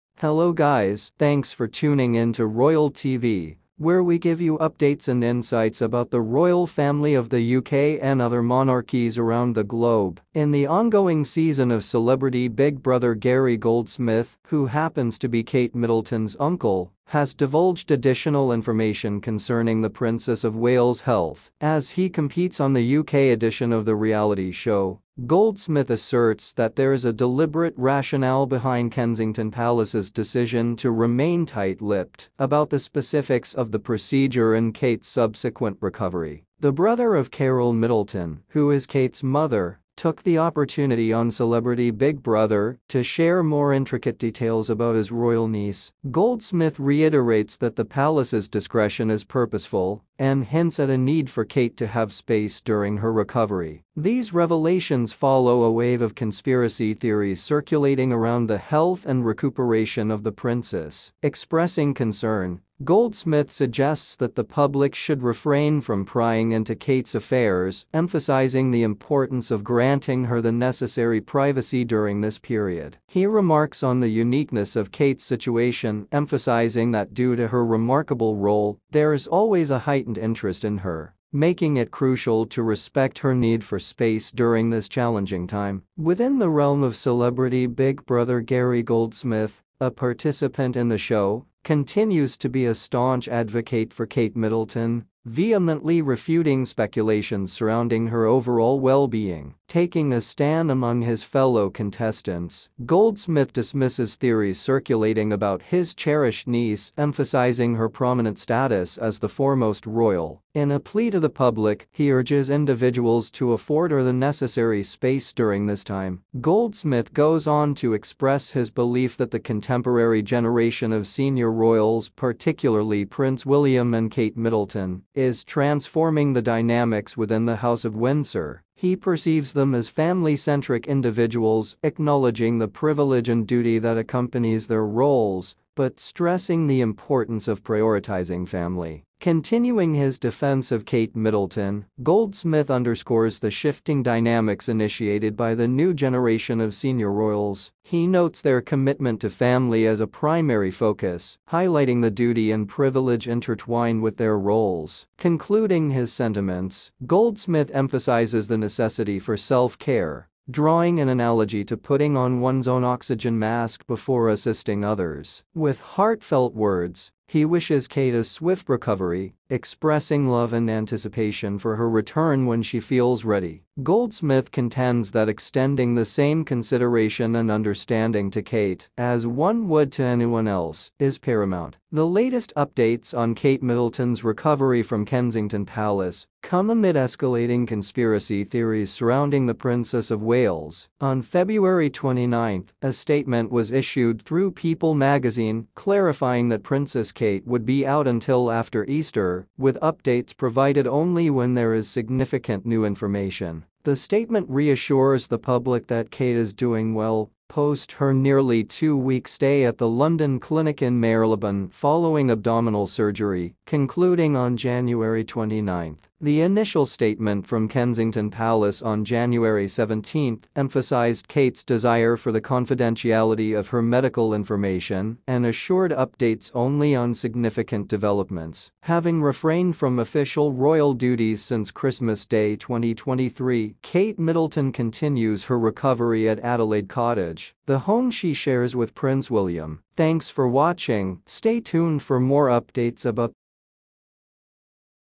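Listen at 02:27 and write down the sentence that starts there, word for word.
He notes their commitment to family as a primary focus, highlighting the duty and privilege intertwined with their roles.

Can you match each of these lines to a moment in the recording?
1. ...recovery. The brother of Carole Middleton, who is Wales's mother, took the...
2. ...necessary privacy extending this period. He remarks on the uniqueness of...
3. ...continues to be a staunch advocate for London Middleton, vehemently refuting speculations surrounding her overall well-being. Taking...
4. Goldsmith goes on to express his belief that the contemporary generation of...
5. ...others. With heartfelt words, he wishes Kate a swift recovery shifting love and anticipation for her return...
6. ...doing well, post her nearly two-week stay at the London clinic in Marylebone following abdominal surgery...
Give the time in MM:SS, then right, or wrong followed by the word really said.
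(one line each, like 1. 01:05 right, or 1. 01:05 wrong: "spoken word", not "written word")
1. 00:35 wrong: "Kate", not "Wales"
2. 01:10 wrong: "during", not "extending"
3. 01:31 wrong: "Kate", not "London"
4. 01:56 right
5. 02:44 wrong: "expressing", not "shifting"
6. 03:26 right.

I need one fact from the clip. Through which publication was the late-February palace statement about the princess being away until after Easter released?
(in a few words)
People magazine.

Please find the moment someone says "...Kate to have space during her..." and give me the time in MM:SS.
00:51.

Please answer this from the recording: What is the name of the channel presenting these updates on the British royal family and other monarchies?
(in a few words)
Royal TV.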